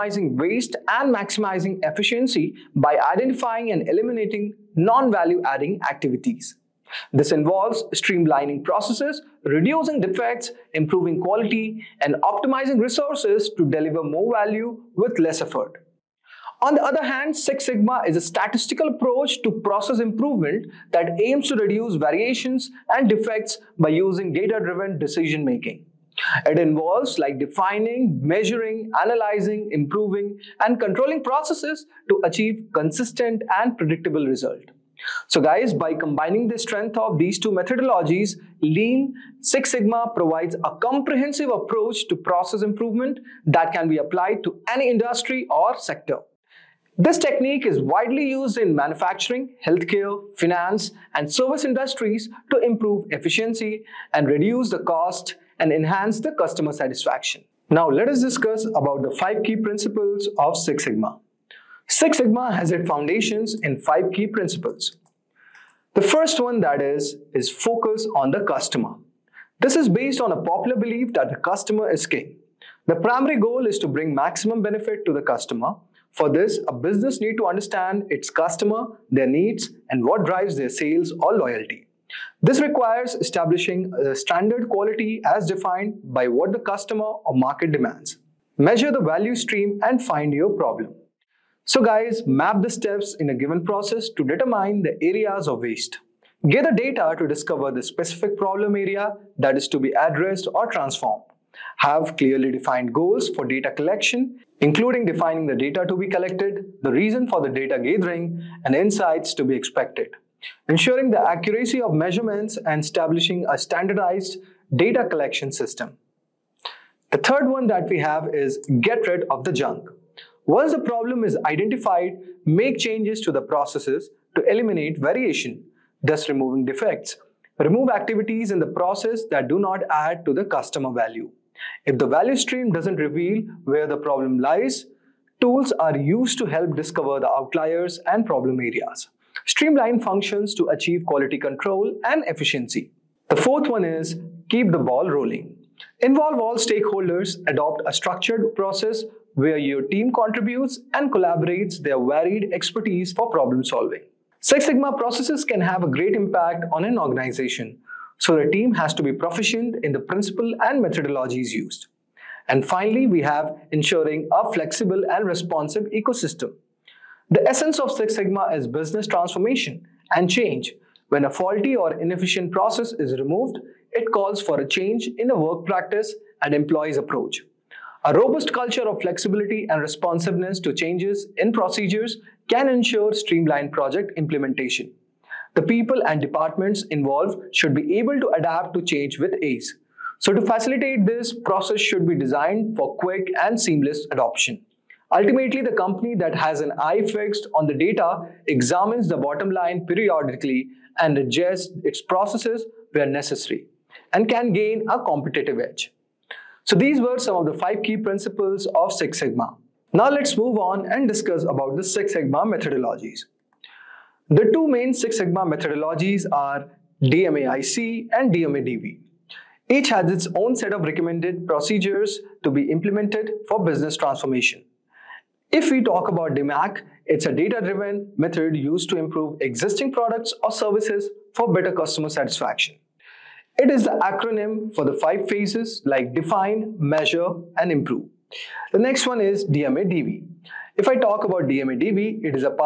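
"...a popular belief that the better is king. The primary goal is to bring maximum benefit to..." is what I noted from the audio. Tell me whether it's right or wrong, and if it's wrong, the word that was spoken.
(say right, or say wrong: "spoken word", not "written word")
wrong: "customer", not "better".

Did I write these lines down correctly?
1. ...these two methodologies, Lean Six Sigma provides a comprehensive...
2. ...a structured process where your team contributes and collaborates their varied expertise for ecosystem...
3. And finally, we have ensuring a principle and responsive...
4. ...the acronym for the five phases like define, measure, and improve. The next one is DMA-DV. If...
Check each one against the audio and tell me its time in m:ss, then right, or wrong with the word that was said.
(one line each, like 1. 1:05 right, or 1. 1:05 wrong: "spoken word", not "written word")
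1. 0:37 right
2. 2:27 wrong: "problem", not "ecosystem"
3. 2:42 wrong: "flexible", not "principle"
4. 3:53 right.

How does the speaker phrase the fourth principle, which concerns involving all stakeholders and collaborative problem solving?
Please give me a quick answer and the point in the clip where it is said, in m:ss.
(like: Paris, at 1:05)
Keep the ball rolling, at 2:24.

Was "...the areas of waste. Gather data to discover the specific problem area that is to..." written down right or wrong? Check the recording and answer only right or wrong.
right.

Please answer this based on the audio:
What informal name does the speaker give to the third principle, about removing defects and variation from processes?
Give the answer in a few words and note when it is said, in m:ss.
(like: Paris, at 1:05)
Get rid of the junk, at 1:58.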